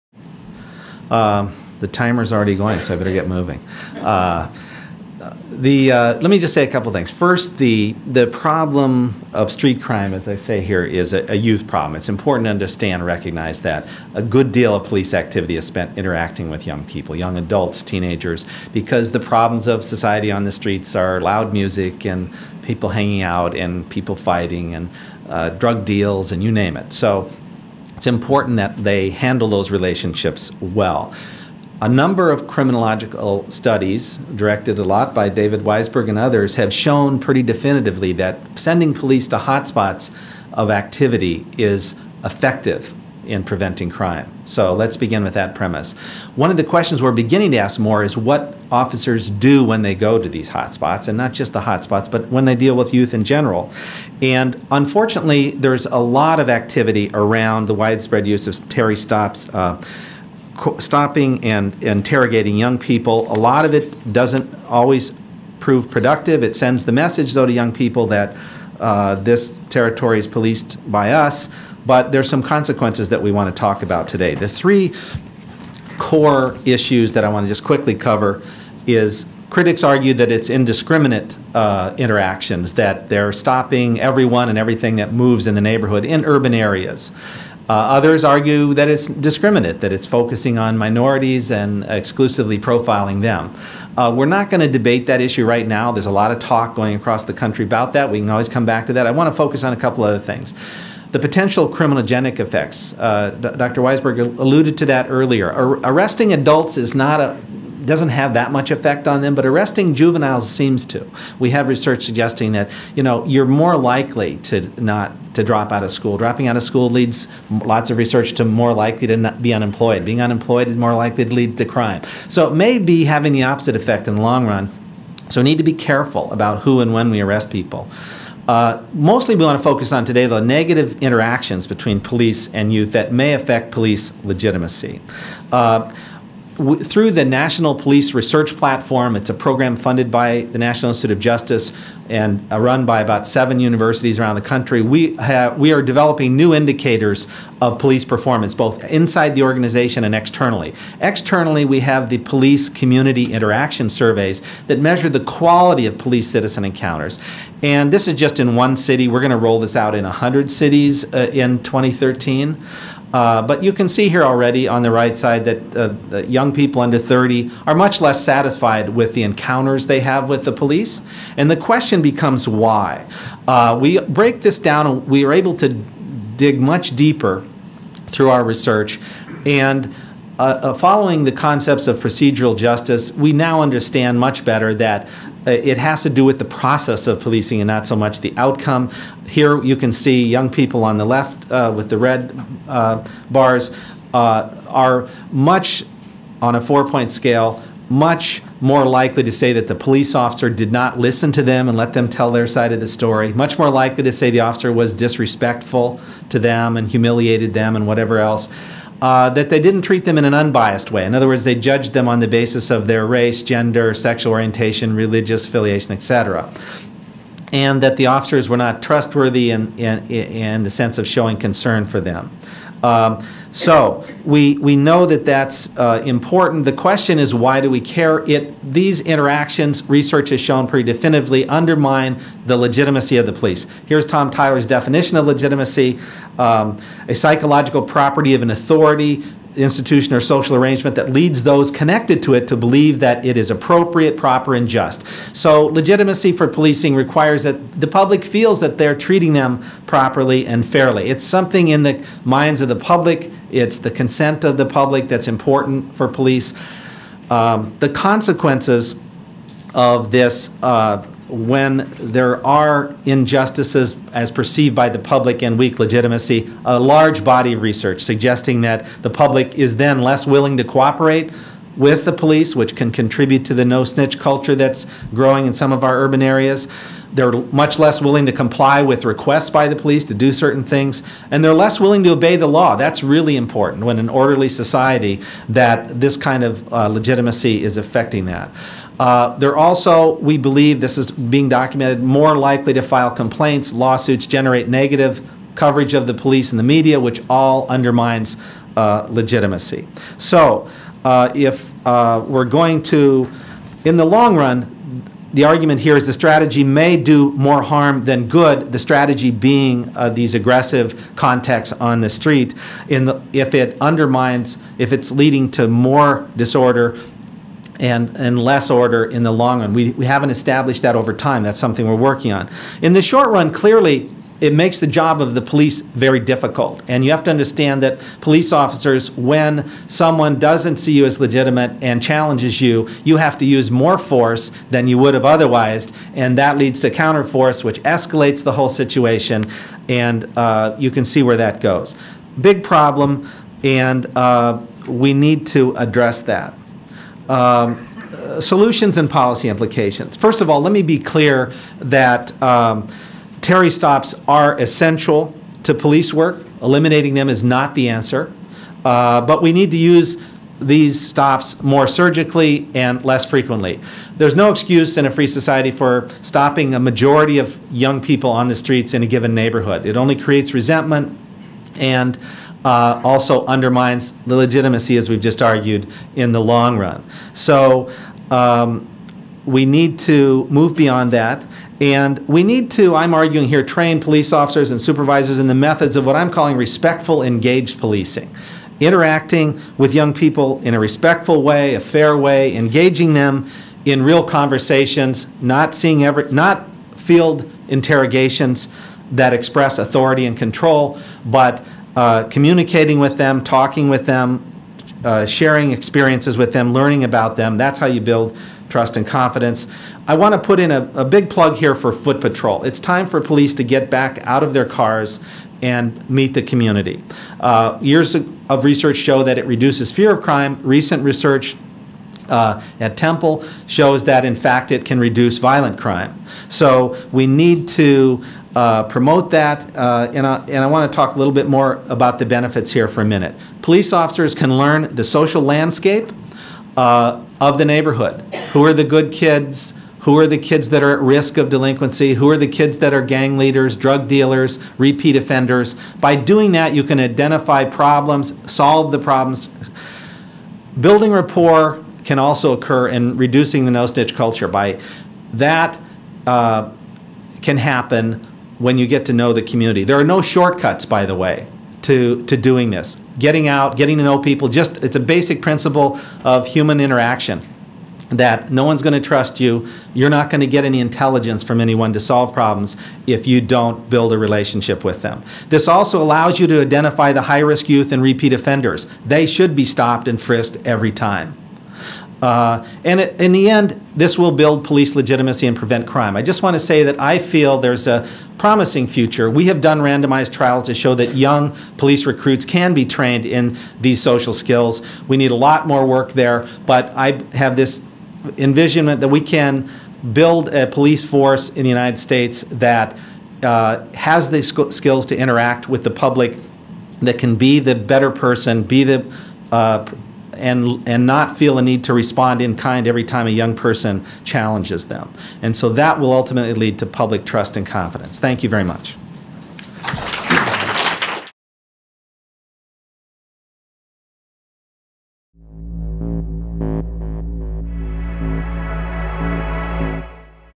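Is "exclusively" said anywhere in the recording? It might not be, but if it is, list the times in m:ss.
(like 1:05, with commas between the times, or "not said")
1:31.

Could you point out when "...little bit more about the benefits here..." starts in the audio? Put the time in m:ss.
7:11.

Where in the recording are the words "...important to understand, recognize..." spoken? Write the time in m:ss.
0:12.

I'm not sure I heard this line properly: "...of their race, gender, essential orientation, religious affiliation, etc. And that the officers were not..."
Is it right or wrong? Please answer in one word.
wrong.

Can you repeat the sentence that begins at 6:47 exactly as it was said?
That's how you build trust and confidence.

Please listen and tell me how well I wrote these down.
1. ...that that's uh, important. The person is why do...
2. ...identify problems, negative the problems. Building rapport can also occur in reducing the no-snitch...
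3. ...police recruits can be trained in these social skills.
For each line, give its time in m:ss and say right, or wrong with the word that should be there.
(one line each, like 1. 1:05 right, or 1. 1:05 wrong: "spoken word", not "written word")
1. 3:45 wrong: "question", not "person"
2. 7:26 wrong: "solve", not "negative"
3. 8:11 right.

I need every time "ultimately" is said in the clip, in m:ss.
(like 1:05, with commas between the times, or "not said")
8:36.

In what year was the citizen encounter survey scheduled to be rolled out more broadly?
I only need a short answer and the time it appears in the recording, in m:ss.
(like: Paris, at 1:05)
2013, at 2:41.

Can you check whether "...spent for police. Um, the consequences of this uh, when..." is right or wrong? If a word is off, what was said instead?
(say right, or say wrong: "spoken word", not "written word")
wrong: "important", not "spent".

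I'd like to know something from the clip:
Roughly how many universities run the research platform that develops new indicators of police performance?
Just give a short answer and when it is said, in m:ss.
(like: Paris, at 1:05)
7, at 2:23.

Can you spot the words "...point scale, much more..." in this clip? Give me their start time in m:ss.
3:16.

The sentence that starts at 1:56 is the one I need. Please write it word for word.
Dropping out of school leads lots of research to more likely to not be unemployed.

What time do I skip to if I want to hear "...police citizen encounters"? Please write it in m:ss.
2:35.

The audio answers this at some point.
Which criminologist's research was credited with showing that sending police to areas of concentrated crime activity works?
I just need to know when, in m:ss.
0:35.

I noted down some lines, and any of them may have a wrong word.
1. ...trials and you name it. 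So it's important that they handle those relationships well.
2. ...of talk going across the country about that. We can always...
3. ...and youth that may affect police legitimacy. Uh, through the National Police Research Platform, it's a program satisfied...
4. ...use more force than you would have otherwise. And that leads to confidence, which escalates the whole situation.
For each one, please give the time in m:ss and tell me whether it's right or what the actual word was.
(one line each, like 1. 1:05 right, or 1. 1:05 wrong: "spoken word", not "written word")
1. 0:25 wrong: "deals", not "trials"
2. 1:36 right
3. 2:12 wrong: "funded", not "satisfied"
4. 5:33 wrong: "counterforce", not "confidence".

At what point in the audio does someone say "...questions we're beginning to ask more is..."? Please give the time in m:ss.
0:46.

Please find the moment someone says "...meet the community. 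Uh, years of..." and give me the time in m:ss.
6:56.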